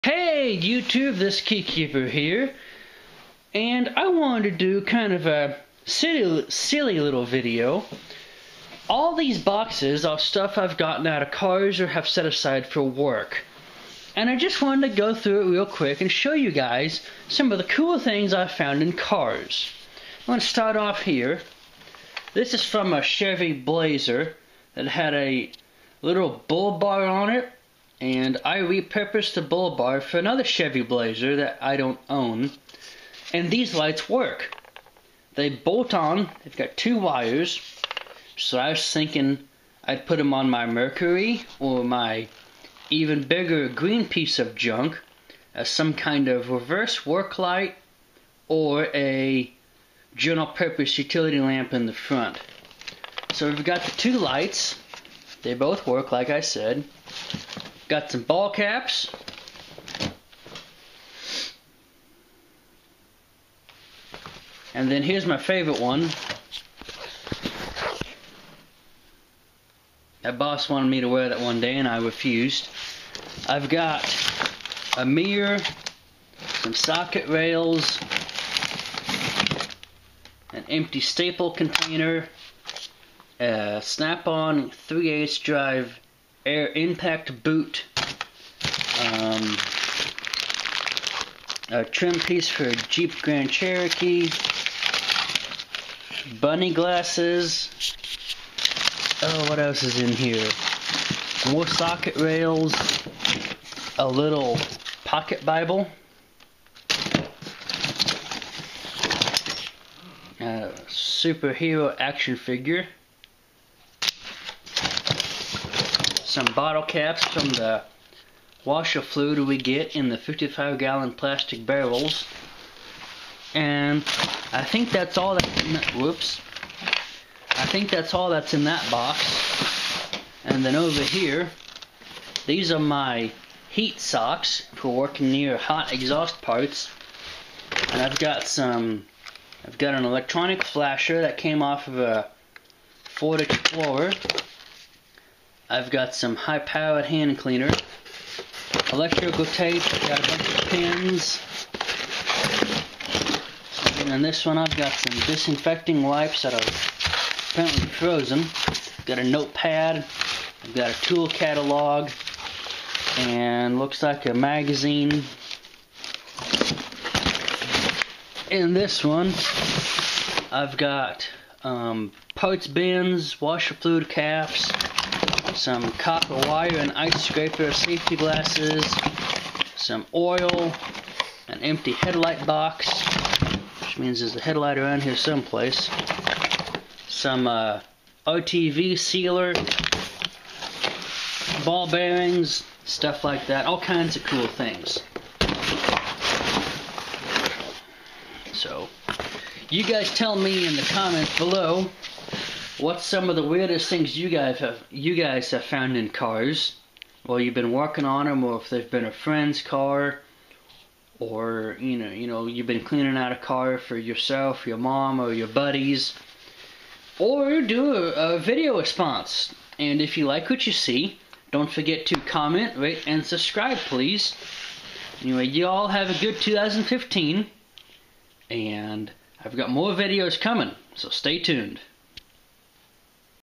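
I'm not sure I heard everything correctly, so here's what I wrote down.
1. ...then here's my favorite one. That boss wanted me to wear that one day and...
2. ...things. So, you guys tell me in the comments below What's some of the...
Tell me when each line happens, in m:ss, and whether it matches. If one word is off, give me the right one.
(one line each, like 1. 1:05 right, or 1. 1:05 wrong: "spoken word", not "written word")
1. 1:04 right
2. 3:14 right.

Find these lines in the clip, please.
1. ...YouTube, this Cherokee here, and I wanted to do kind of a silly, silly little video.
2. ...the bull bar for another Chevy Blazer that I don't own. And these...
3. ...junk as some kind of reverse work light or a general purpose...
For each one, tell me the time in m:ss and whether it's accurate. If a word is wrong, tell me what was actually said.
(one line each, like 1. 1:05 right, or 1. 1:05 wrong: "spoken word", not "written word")
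1. 0:00 wrong: "Keykeeper", not "Cherokee"
2. 0:29 right
3. 0:44 right.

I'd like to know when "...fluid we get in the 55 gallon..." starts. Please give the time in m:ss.
1:59.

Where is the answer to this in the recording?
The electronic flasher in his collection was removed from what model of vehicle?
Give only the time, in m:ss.
2:23.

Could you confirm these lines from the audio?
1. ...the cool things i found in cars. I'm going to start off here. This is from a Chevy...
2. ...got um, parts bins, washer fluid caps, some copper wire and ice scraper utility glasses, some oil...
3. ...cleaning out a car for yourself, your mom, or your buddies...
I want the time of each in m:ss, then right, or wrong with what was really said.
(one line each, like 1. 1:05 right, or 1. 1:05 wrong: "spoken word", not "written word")
1. 0:17 right
2. 2:50 wrong: "safety", not "utility"
3. 3:32 right.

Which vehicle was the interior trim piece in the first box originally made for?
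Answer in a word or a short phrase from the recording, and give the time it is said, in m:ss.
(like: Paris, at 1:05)
Jeep Grand Cherokee, at 1:32.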